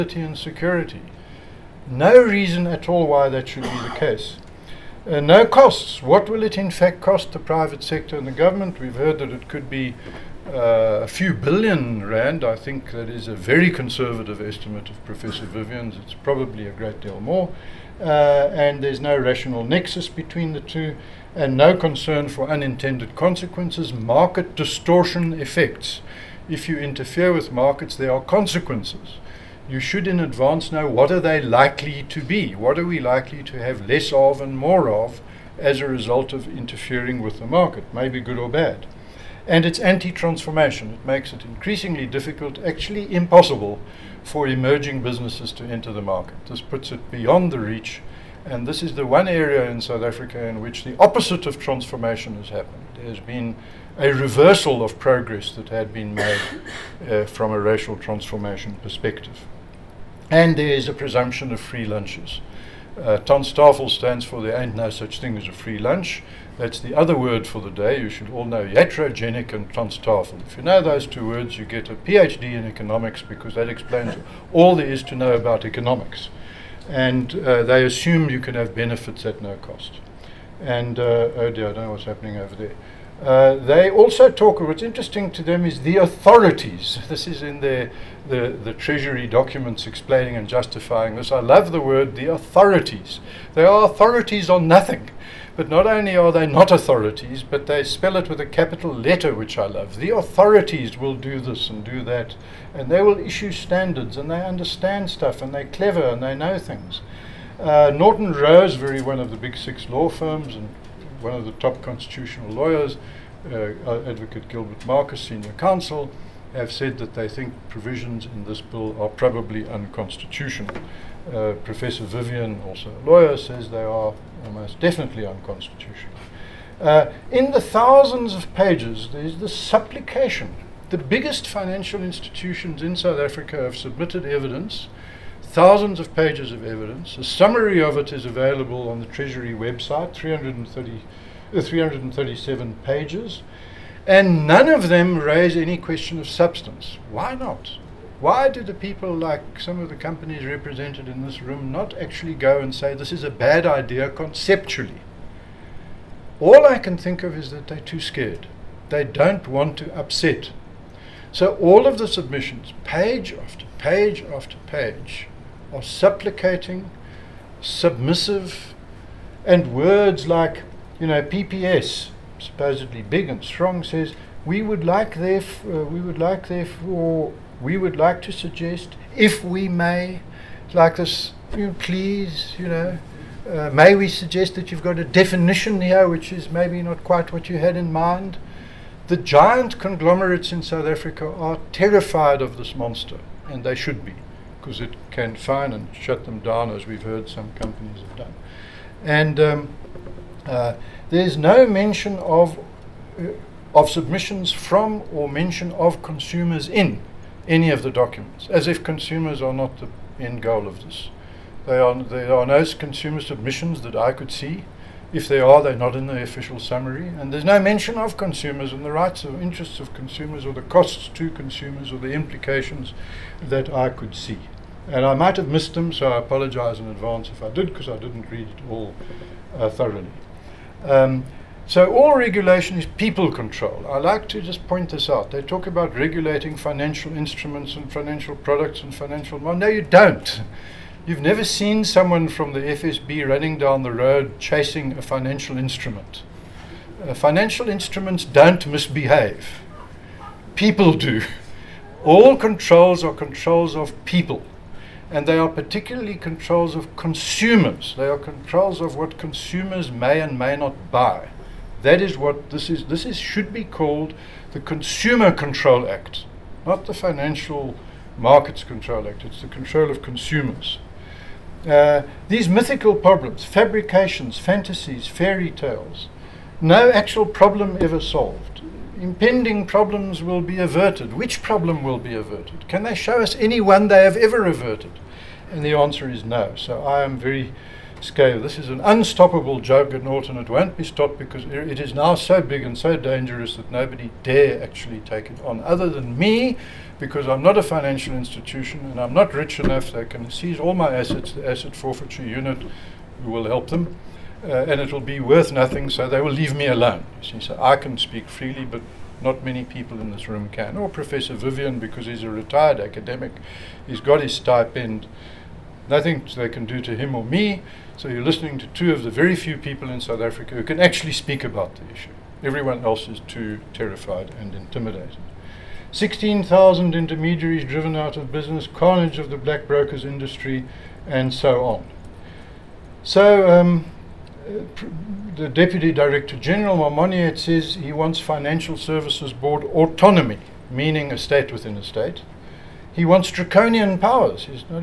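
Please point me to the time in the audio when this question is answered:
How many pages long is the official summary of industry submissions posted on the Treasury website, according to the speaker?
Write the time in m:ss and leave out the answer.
2:21.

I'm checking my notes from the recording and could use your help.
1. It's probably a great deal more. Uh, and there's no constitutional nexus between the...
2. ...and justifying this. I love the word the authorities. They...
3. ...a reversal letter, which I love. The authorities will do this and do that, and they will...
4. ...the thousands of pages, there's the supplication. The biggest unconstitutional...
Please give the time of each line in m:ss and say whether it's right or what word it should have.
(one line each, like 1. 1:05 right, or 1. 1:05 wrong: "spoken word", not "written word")
1. 0:16 wrong: "rational", not "constitutional"
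2. 1:30 right
3. 1:38 wrong: "capital", not "reversal"
4. 2:07 wrong: "financial", not "unconstitutional".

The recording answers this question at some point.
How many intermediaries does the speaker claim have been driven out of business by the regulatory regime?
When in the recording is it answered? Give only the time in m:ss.
5:25.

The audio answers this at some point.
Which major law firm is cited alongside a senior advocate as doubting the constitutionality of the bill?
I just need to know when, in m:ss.
1:47.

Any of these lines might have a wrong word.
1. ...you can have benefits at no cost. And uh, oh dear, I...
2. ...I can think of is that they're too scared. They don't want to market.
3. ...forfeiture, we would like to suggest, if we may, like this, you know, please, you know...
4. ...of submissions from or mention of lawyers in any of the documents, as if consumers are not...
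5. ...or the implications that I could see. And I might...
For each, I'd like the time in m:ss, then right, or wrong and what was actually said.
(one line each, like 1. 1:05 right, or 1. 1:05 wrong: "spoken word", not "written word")
1. 1:18 right
2. 2:36 wrong: "upset", not "market"
3. 2:56 wrong: "therefore", not "forfeiture"
4. 3:23 wrong: "consumers", not "lawyers"
5. 3:41 right.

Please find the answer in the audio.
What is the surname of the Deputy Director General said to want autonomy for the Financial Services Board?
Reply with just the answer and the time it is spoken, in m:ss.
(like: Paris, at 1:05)
Momoniat, at 5:36.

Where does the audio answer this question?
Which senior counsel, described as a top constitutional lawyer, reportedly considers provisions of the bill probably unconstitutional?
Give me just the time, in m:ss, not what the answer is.
1:54.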